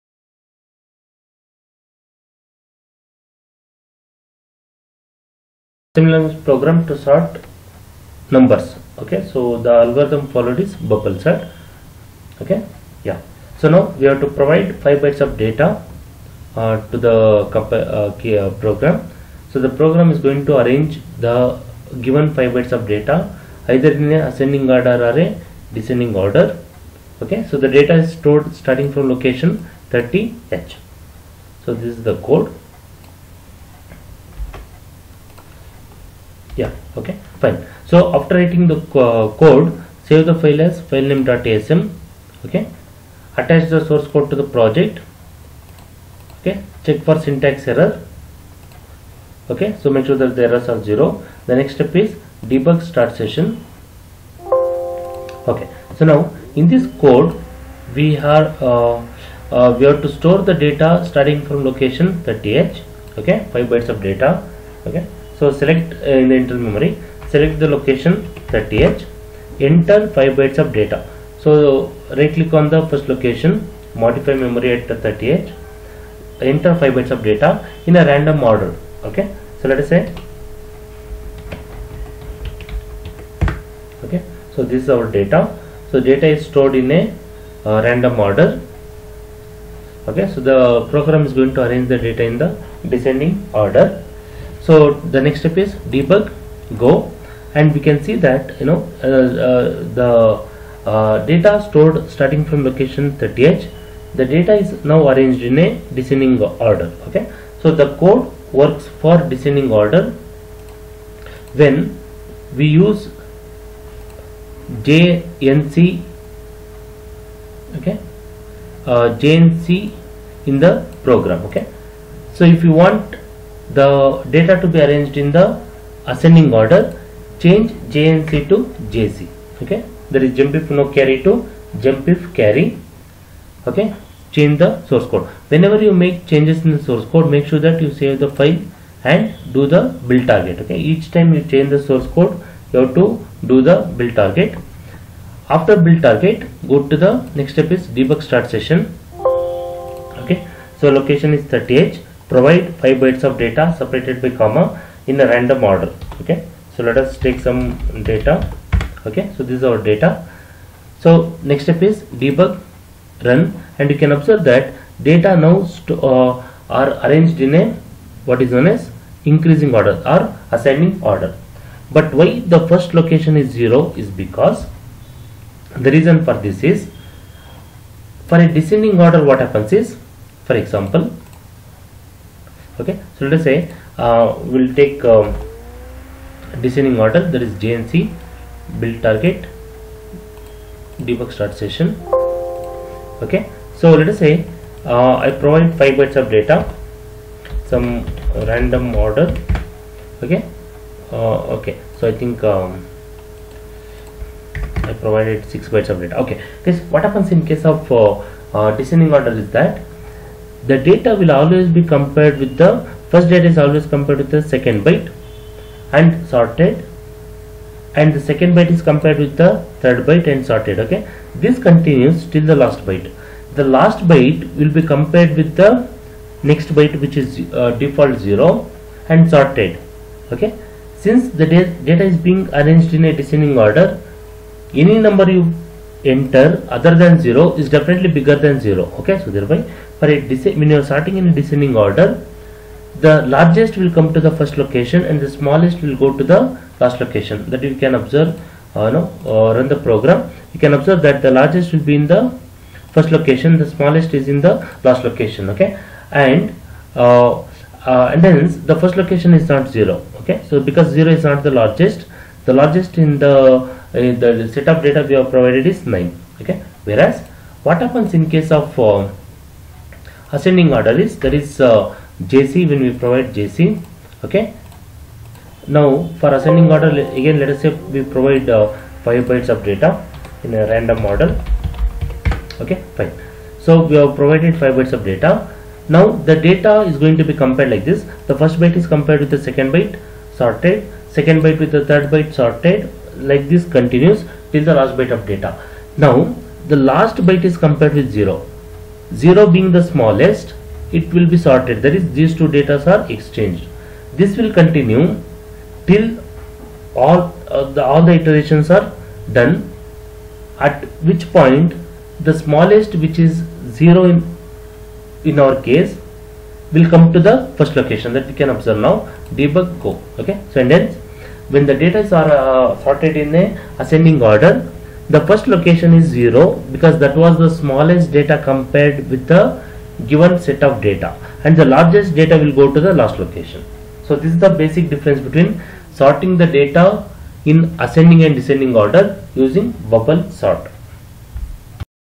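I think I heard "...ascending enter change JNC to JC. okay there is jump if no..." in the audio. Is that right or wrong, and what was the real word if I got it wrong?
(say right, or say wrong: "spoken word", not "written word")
wrong: "order", not "enter".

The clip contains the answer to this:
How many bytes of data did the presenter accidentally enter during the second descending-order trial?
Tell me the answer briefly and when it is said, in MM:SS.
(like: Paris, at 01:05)
6, at 03:25.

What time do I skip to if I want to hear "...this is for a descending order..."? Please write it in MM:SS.
02:56.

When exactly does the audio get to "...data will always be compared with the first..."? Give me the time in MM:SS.
03:30.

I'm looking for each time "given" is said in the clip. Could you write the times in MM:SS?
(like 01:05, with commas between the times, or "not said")
00:22, 05:30.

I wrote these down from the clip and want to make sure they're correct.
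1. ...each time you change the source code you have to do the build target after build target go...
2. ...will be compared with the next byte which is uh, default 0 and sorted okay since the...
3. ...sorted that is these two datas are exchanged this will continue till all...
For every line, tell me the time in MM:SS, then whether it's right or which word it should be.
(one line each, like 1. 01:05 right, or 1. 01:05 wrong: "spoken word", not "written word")
1. 02:20 right
2. 03:44 right
3. 05:01 right.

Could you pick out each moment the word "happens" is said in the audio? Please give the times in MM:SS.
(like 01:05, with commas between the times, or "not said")
02:59, 03:27, 04:27.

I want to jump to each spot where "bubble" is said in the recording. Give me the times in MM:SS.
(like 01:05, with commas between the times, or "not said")
00:10, 05:39.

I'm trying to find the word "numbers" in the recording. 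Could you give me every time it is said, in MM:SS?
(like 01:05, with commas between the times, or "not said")
00:08, 03:55.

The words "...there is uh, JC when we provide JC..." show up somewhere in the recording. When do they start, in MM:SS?
04:31.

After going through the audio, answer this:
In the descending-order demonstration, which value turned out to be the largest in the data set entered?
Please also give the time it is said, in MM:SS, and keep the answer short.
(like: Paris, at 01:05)
9, at 04:25.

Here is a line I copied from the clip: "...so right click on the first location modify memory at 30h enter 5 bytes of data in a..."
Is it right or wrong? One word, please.
right.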